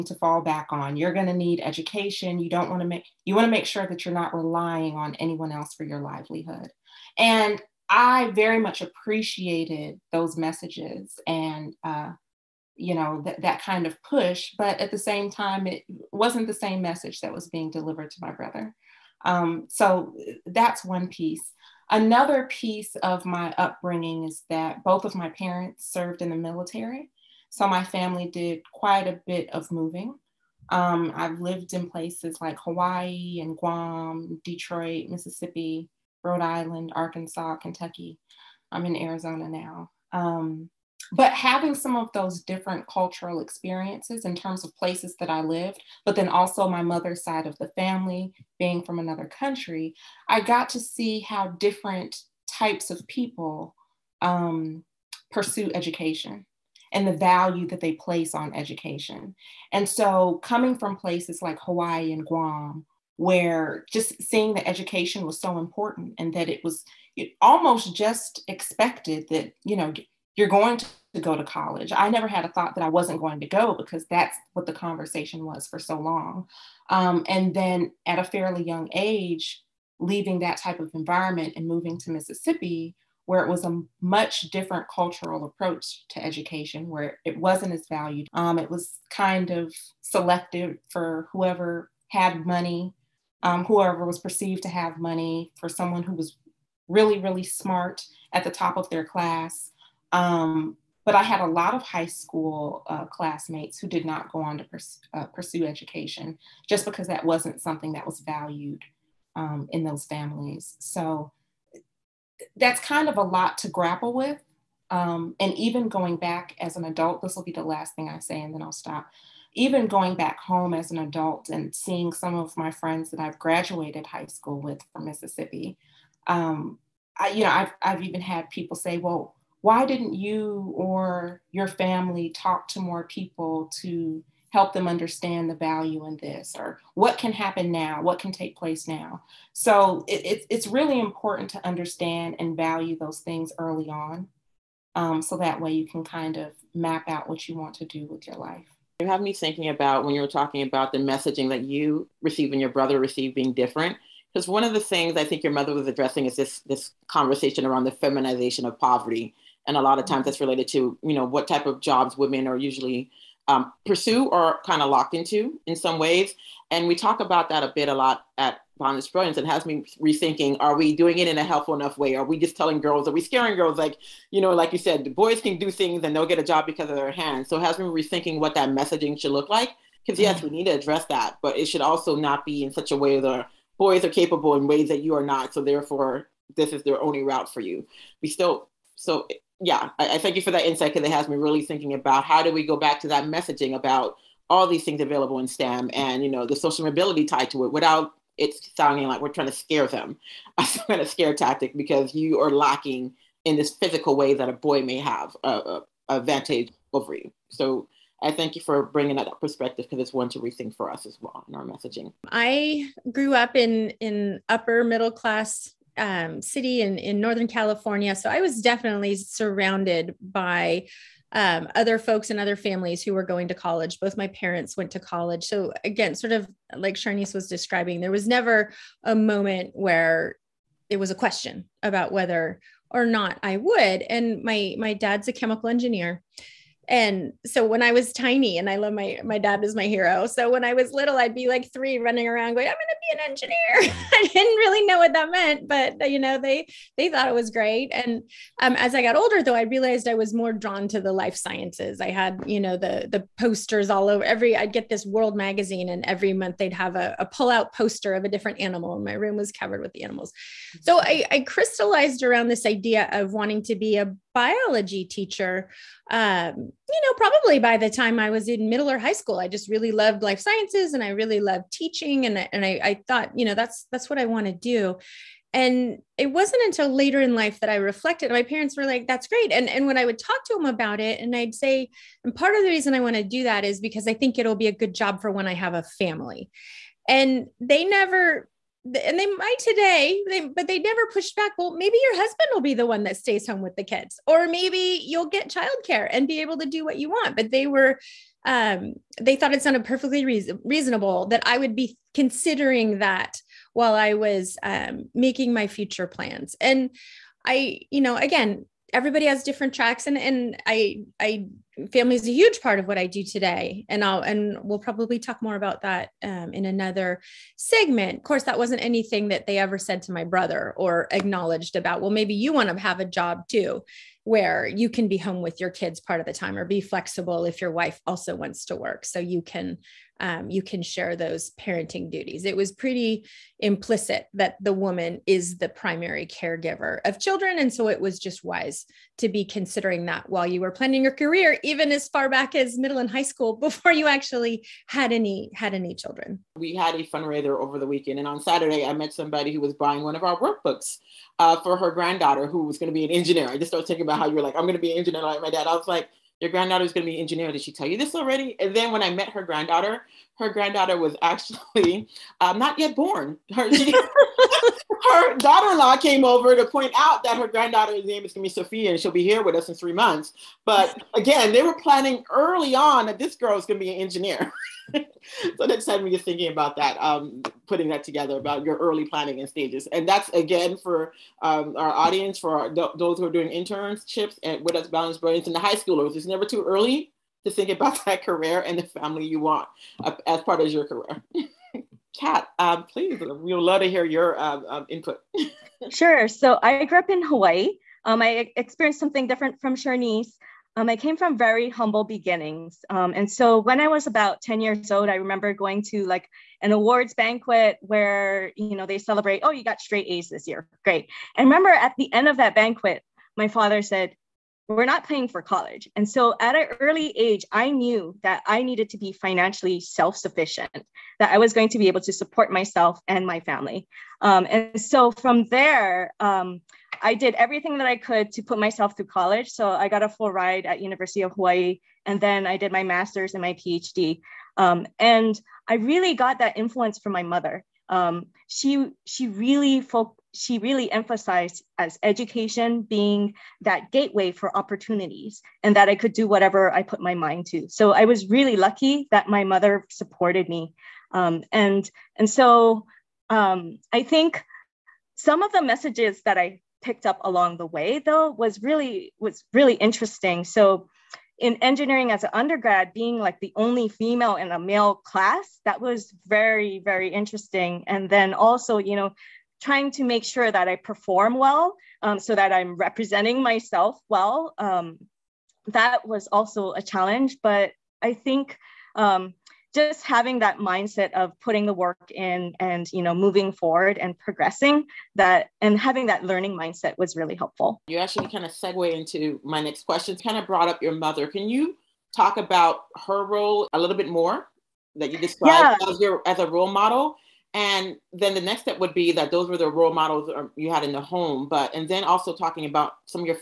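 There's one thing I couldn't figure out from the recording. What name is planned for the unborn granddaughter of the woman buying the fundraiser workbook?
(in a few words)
Sophia.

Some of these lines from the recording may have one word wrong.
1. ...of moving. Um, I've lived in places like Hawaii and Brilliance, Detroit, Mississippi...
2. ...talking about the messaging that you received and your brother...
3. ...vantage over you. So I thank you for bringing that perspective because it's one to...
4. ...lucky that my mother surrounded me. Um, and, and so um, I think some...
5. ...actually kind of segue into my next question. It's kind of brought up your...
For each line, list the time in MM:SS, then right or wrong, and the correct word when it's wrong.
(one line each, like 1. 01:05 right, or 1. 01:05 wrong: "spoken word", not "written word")
1. 00:29 wrong: "Guam", not "Brilliance"
2. 02:30 right
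3. 03:26 right
4. 07:28 wrong: "supported", not "surrounded"
5. 08:07 right.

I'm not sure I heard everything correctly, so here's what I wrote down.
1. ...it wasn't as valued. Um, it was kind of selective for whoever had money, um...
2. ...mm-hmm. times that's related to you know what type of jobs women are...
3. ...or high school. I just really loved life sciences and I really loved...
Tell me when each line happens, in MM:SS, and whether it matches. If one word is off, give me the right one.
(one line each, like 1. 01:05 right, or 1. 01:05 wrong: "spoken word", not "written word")
1. 01:27 right
2. 02:40 right
3. 04:28 right.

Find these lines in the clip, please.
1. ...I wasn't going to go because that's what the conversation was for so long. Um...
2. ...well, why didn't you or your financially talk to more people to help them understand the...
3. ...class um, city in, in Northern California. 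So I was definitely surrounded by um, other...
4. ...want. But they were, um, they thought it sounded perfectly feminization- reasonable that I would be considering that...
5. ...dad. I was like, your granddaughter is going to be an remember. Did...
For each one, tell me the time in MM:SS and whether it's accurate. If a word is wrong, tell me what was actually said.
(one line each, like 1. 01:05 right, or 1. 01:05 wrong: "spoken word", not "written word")
1. 01:12 right
2. 02:08 wrong: "family", not "financially"
3. 03:35 right
4. 04:57 wrong: "reason", not "feminization"
5. 05:55 wrong: "engineer", not "remember".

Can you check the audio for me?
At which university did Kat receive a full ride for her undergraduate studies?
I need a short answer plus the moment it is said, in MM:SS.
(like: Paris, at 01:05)
University of Hawaii, at 07:10.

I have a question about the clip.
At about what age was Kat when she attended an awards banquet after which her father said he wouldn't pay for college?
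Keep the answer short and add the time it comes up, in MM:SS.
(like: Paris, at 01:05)
10, at 06:44.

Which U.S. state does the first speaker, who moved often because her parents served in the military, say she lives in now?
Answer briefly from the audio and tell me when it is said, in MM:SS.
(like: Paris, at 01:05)
Arizona, at 00:38.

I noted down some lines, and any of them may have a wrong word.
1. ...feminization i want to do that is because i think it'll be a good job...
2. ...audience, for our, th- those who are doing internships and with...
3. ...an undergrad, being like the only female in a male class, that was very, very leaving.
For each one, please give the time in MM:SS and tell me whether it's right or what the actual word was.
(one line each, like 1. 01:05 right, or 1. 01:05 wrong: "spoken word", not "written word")
1. 04:42 wrong: "reason", not "feminization"
2. 06:21 right
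3. 07:42 wrong: "interesting", not "leaving".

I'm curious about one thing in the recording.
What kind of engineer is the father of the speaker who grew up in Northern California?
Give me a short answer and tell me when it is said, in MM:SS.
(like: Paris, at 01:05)
chemical engineer, at 03:55.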